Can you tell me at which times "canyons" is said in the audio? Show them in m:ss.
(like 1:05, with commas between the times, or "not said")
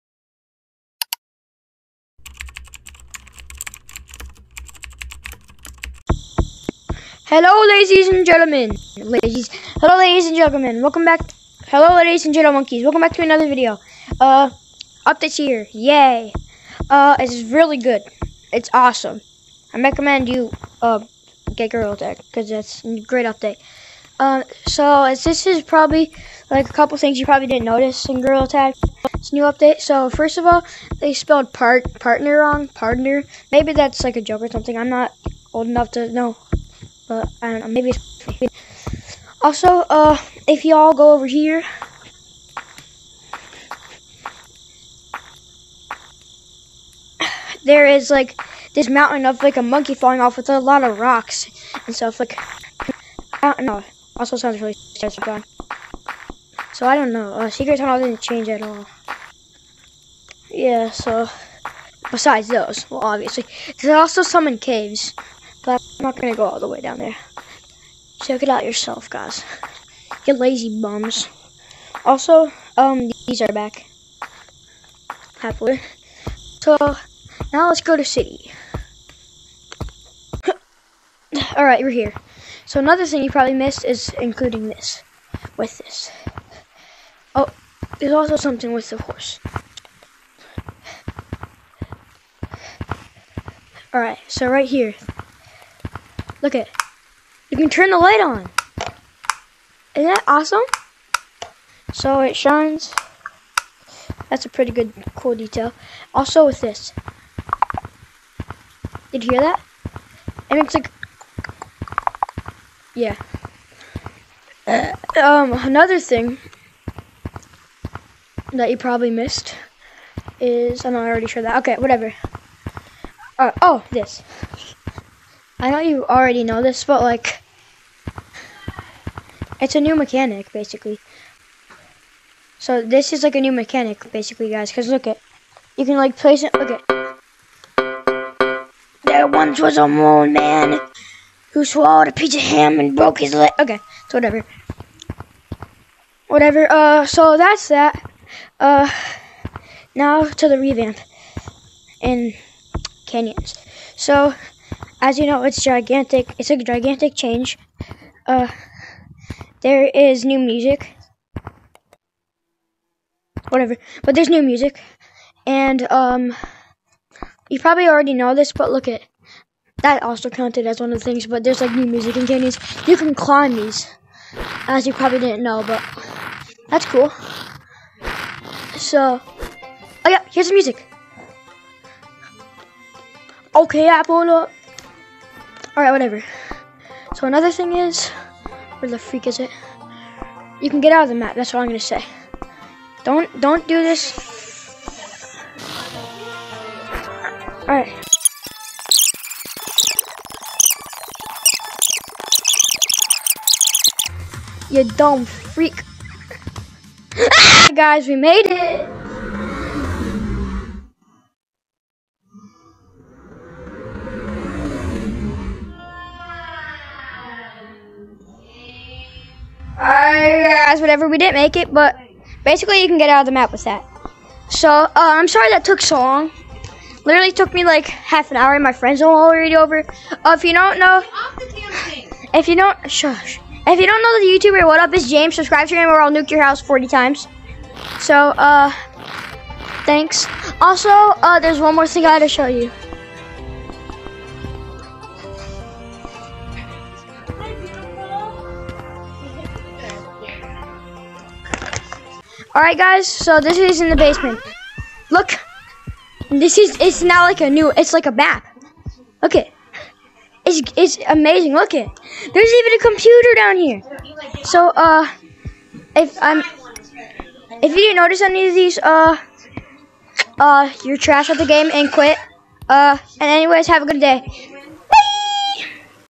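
2:33, 2:52.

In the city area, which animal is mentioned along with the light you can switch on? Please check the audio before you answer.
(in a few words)
horse.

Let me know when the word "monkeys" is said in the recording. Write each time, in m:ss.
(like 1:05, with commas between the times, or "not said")
0:12, 0:49.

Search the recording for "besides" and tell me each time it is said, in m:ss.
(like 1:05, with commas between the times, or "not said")
1:02.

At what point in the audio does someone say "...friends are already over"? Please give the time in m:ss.
3:48.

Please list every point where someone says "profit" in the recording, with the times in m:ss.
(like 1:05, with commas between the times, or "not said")
not said.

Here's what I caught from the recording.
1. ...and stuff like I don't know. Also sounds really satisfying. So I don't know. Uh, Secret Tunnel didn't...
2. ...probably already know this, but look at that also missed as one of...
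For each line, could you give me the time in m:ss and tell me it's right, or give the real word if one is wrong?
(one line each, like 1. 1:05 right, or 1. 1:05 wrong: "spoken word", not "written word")
1. 0:51 right
2. 2:47 wrong: "counted", not "missed".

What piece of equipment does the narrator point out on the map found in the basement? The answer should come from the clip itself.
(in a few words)
computer.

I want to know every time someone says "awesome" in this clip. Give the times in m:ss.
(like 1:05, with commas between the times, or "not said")
0:18, 1:40.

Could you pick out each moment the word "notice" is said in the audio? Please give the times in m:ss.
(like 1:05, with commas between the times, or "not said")
0:27, 4:27.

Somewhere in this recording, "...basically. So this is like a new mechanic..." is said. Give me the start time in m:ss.
2:10.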